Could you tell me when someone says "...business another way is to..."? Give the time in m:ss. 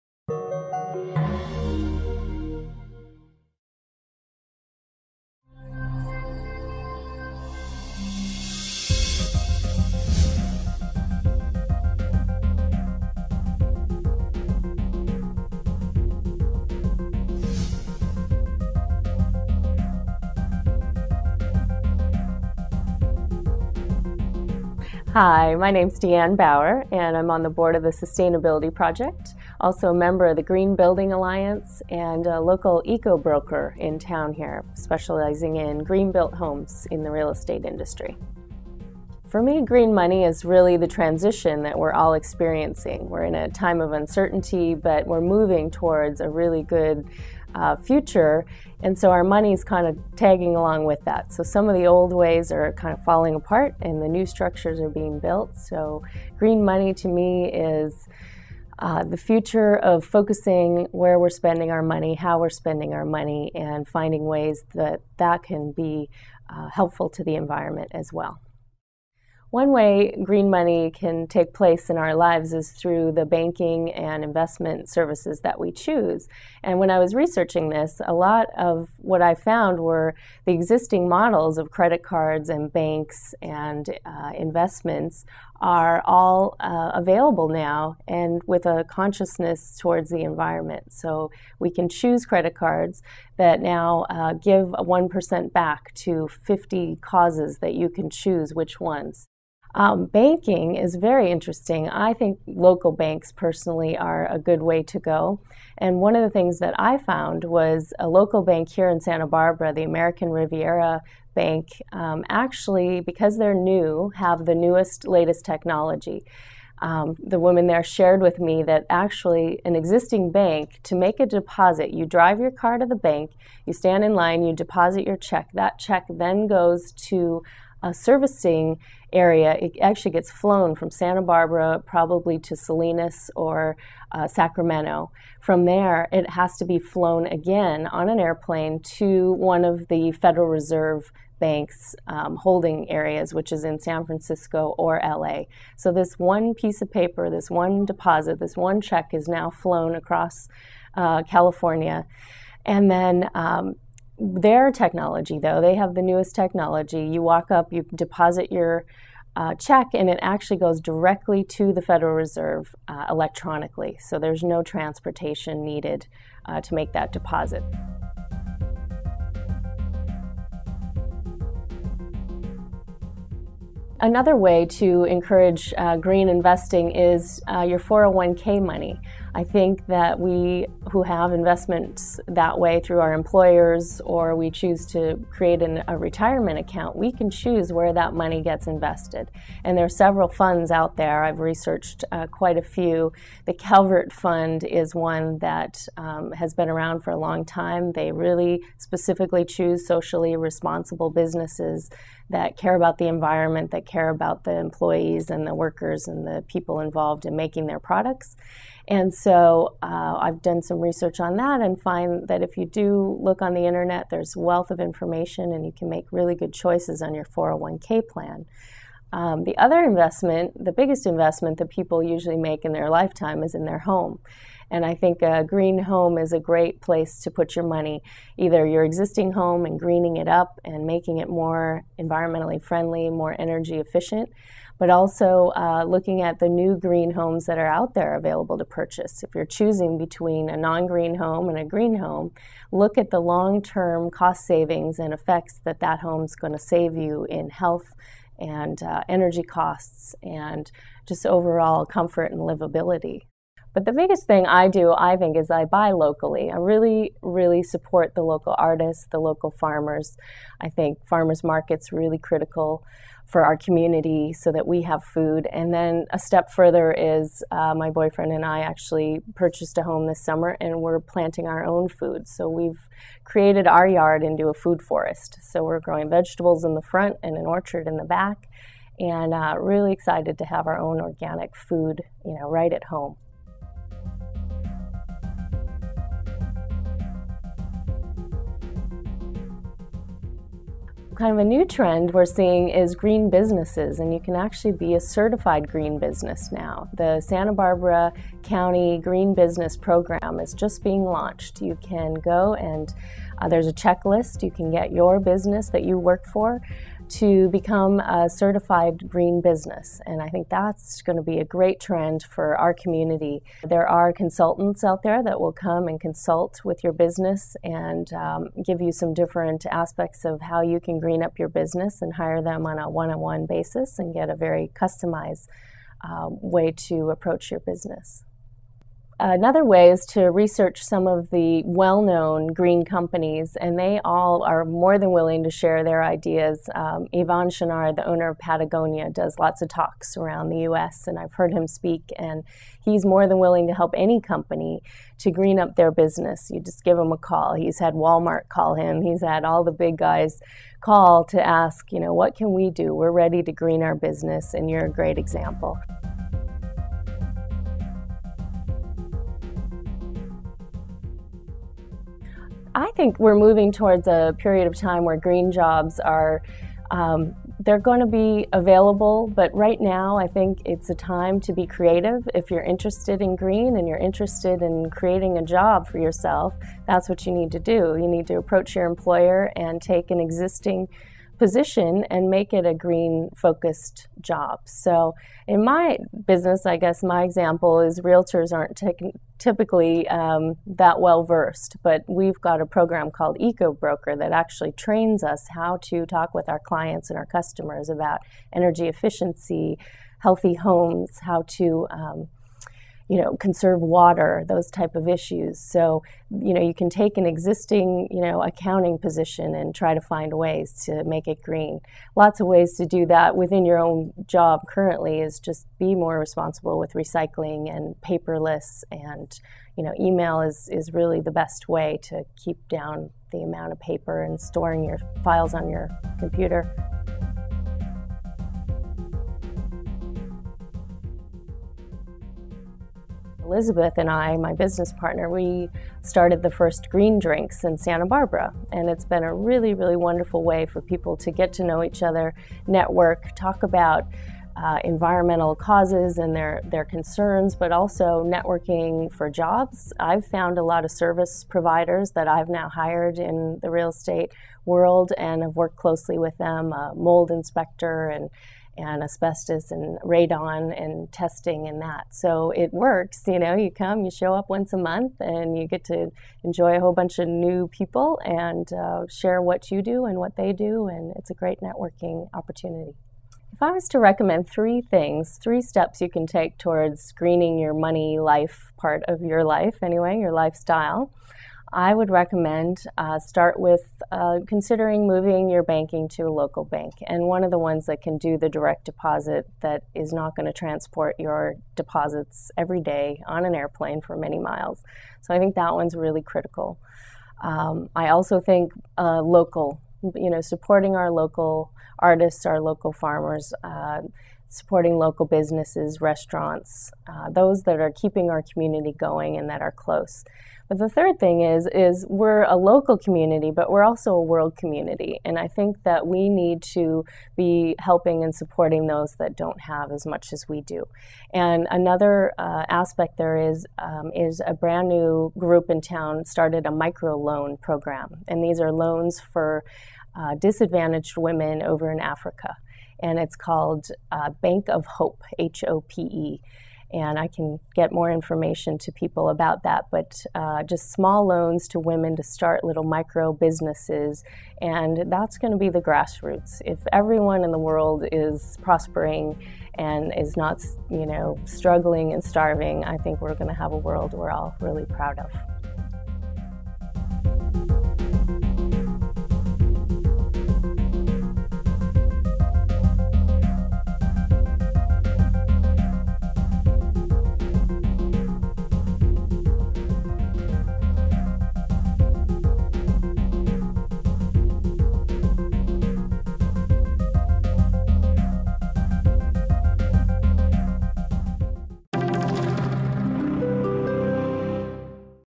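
5:27.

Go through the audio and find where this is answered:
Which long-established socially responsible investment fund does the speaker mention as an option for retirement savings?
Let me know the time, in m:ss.
3:13.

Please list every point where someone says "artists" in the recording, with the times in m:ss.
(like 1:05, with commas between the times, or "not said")
4:18, 8:21.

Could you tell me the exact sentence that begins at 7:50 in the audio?
And it's a great networking opportunity.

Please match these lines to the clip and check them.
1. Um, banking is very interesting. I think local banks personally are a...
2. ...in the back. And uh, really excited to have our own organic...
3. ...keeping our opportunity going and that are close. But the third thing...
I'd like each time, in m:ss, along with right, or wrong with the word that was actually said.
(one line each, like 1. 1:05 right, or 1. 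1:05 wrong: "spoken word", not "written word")
1. 1:39 right
2. 4:37 right
3. 8:27 wrong: "community", not "opportunity".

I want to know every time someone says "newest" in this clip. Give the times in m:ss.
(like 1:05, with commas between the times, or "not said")
1:54, 2:36.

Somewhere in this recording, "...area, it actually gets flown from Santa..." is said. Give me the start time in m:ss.
2:09.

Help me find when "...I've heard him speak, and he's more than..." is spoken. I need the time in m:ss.
5:41.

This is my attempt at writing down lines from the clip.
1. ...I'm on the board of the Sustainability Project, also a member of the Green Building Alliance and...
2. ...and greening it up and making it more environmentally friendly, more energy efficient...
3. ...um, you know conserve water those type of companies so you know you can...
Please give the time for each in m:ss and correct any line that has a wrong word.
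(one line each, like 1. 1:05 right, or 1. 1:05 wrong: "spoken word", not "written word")
1. 0:27 right
2. 3:49 right
3. 6:41 wrong: "issues", not "companies".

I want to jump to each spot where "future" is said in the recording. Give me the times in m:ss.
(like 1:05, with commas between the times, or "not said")
0:47, 0:59.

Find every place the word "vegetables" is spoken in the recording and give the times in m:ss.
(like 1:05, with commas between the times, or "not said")
4:36.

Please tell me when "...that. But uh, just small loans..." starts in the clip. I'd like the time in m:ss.
8:59.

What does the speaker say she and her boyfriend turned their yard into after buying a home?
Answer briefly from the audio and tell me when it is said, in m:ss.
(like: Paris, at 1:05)
a food forest, at 4:34.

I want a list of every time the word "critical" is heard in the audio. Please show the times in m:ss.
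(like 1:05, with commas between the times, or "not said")
4:22, 8:16.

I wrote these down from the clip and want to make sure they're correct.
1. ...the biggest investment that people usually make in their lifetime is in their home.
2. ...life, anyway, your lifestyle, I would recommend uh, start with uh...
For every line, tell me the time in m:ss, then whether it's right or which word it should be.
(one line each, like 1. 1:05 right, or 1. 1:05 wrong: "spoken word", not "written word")
1. 3:40 right
2. 7:59 right.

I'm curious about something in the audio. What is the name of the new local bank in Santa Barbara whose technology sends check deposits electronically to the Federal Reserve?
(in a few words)
American Riviera Bank.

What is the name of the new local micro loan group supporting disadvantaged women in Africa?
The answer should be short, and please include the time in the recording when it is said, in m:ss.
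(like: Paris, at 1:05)
Bank of Hope, at 8:54.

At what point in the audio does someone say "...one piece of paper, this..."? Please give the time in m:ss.
2:26.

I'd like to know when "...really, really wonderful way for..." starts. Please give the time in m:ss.
7:19.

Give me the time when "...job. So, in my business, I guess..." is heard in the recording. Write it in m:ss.
6:24.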